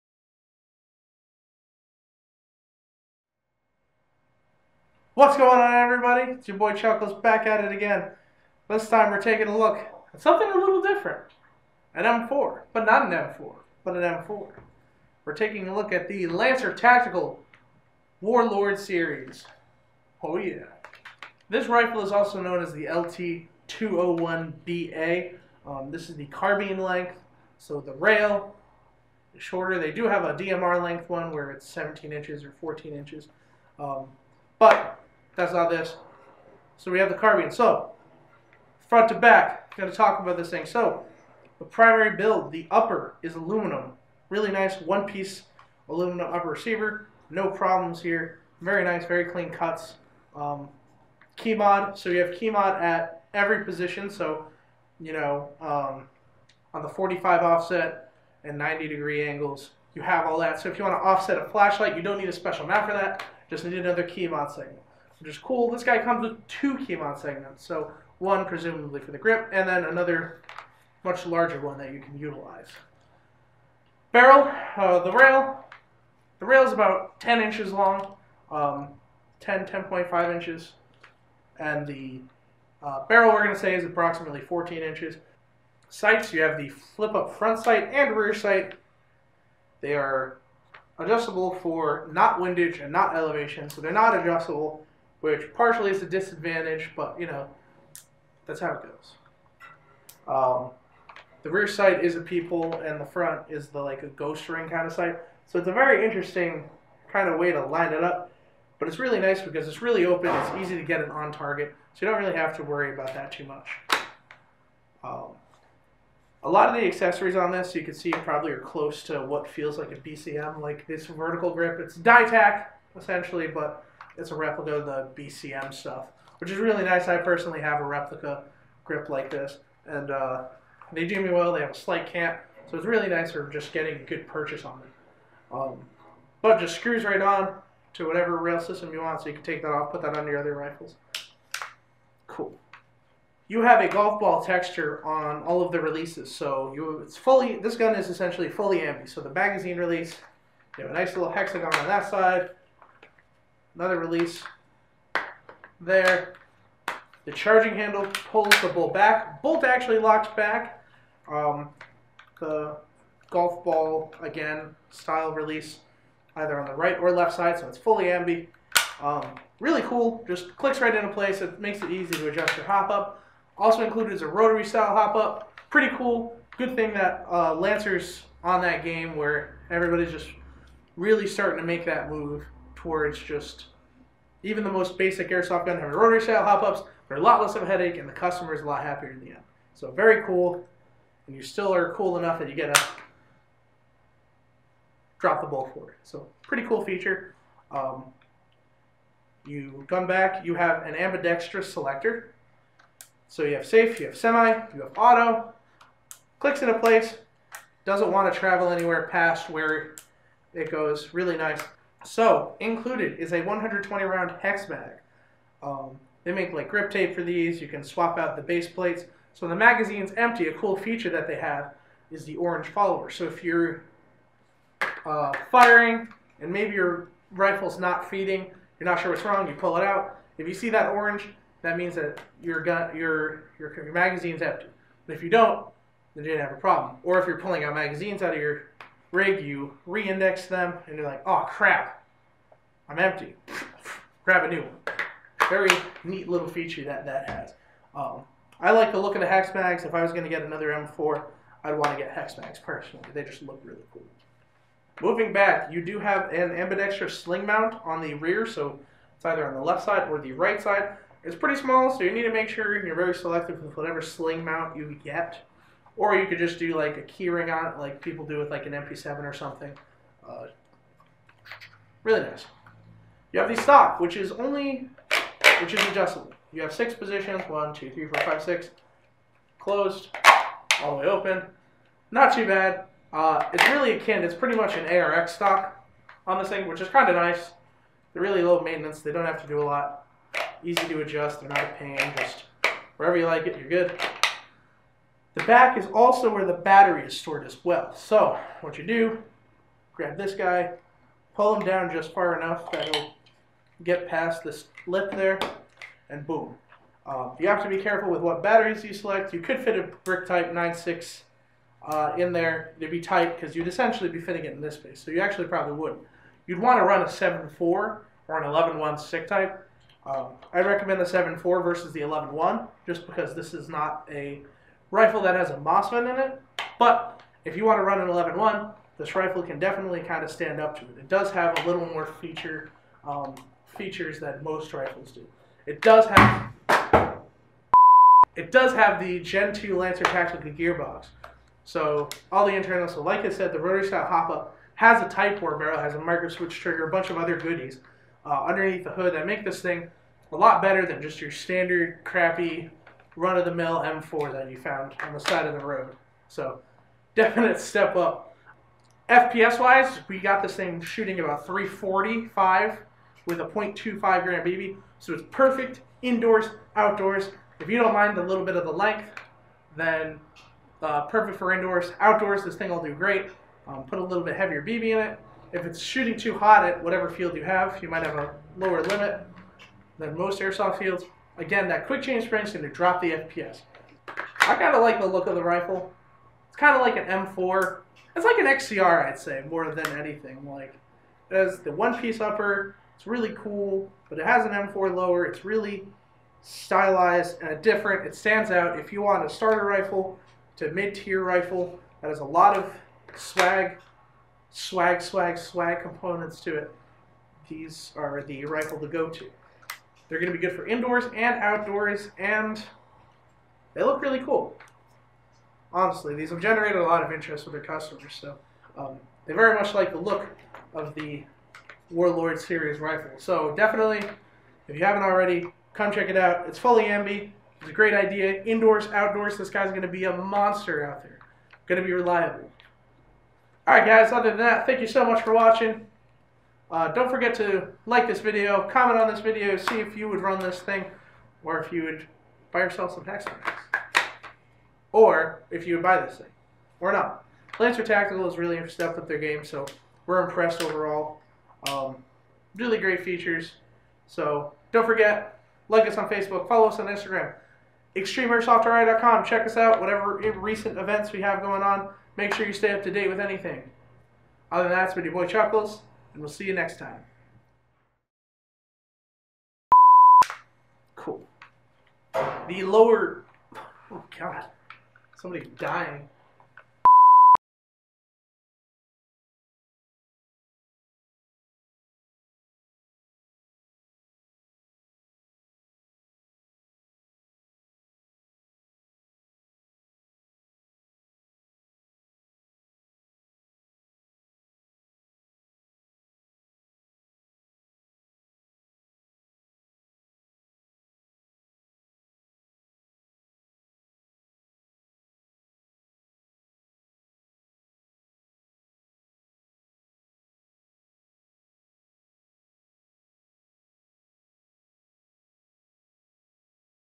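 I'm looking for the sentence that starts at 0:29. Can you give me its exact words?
They do have a DMR length one where it's 17 inches or 14 inches.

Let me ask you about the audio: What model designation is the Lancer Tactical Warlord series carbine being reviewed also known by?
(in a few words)
LT201BA.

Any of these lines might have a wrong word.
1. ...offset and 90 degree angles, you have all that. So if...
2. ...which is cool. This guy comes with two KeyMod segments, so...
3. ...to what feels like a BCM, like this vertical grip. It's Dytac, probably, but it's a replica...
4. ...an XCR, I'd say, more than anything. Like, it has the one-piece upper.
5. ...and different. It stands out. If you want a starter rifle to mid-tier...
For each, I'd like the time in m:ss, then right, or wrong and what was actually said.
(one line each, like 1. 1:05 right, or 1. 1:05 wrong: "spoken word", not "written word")
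1. 0:57 right
2. 1:05 right
3. 1:59 wrong: "essentially", not "probably"
4. 6:28 right
5. 6:37 right.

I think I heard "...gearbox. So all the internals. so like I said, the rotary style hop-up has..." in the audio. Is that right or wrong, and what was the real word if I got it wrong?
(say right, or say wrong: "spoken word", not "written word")
right.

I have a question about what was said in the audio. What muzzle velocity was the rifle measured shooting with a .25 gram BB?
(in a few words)
345 FPS.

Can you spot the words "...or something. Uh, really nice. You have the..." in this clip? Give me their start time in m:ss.
4:29.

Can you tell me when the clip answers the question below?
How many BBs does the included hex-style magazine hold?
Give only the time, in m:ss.
3:33.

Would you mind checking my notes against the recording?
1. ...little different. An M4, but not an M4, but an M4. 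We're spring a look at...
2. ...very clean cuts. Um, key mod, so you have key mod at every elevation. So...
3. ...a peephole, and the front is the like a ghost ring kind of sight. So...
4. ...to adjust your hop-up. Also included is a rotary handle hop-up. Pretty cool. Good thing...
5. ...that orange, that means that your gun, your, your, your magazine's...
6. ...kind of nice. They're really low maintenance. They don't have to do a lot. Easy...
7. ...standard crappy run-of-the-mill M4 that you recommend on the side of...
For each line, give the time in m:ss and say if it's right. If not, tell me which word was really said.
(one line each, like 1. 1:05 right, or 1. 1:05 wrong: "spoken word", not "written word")
1. 0:10 wrong: "taking", not "spring"
2. 0:49 wrong: "position", not "elevation"
3. 1:42 right
4. 2:52 wrong: "style", not "handle"
5. 3:50 right
6. 4:46 right
7. 5:51 wrong: "found", not "recommend".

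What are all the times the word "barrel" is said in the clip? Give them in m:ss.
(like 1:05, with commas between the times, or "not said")
1:14, 1:23, 5:45.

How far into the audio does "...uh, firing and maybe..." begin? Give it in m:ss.
3:45.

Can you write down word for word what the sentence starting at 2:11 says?
They have a slight cant, so it's really nice for just getting a good purchase on them.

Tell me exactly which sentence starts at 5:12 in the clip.
It'd be tight because you'd essentially be fitting it in this space.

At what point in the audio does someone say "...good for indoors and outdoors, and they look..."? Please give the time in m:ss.
6:50.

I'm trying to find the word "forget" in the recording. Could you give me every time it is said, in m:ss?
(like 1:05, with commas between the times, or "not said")
7:17, 7:34.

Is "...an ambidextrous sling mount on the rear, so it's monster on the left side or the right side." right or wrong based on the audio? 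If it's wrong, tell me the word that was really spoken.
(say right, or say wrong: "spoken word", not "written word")
wrong: "either", not "monster".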